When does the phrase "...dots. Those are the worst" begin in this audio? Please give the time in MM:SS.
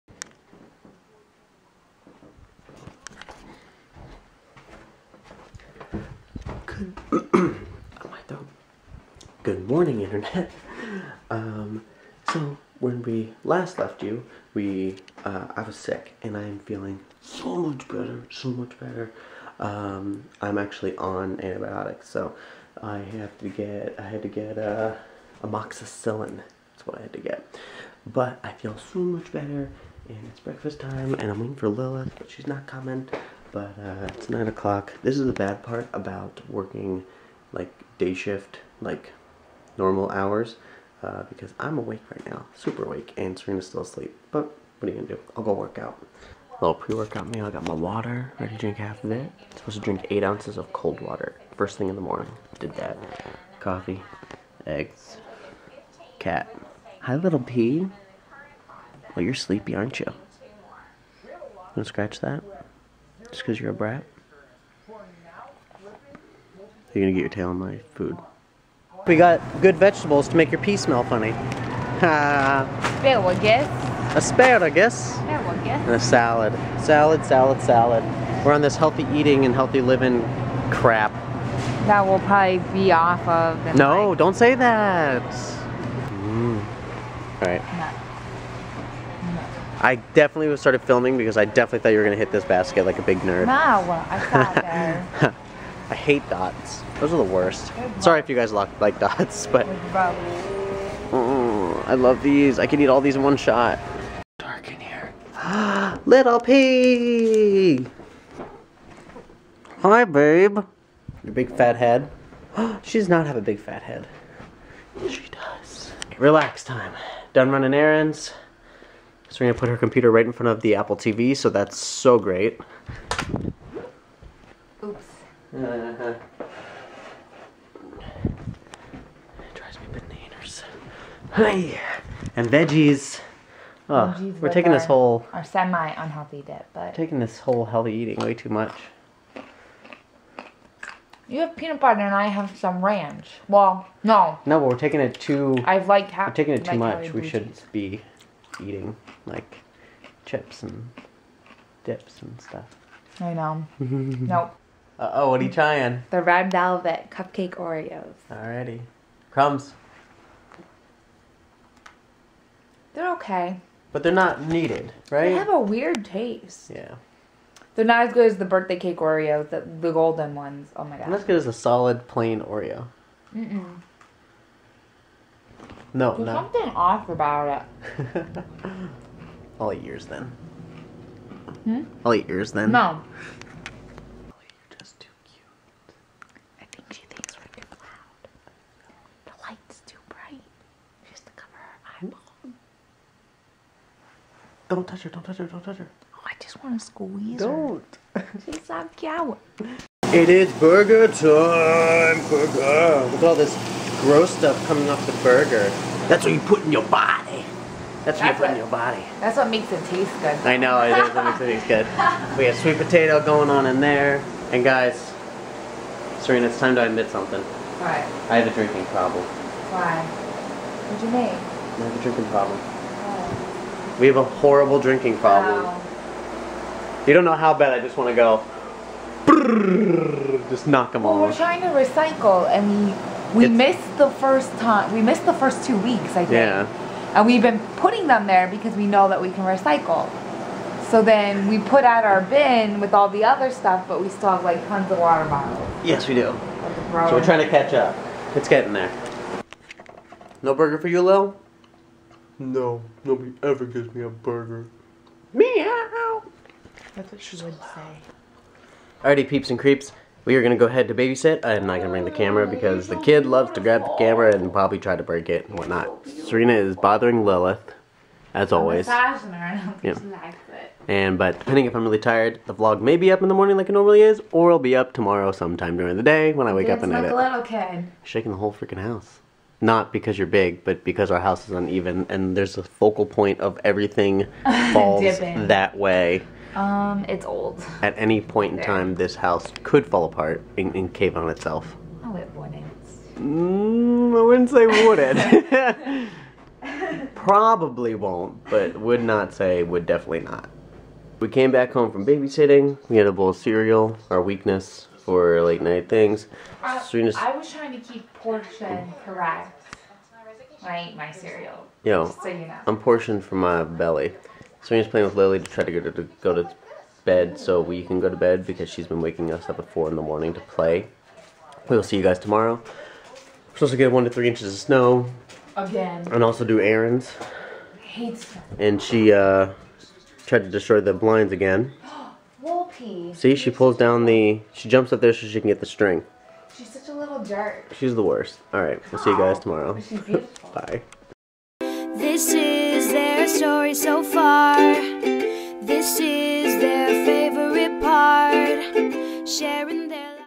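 01:36.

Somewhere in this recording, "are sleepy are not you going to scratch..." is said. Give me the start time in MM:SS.
01:00.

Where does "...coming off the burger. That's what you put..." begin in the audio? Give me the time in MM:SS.
03:24.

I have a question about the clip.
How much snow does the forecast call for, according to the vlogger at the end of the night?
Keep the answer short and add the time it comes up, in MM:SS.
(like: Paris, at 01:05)
1 to 3 inches, at 05:23.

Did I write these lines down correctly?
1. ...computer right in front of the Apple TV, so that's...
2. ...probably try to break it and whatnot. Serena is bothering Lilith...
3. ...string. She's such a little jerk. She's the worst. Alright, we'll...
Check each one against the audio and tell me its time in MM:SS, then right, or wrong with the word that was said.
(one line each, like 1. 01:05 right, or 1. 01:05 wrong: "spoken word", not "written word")
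1. 01:59 right
2. 04:24 right
3. 05:35 right.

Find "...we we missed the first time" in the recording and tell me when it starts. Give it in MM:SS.
03:53.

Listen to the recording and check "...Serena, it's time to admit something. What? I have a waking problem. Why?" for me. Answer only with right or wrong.
wrong.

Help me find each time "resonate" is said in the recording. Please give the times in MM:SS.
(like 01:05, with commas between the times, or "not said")
not said.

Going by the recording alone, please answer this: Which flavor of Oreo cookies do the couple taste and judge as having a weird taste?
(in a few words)
Red velvet cupcake.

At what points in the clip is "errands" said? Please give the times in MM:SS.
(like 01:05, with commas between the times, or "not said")
01:57, 05:26.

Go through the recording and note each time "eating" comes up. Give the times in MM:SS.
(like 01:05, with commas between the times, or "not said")
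01:19, 02:17, 02:28.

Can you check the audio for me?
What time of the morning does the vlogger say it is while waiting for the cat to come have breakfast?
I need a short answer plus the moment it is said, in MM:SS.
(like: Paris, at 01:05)
9 o'clock, at 00:34.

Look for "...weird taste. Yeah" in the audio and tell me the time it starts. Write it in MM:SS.
02:45.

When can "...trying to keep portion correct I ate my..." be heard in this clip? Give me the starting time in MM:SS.
05:07.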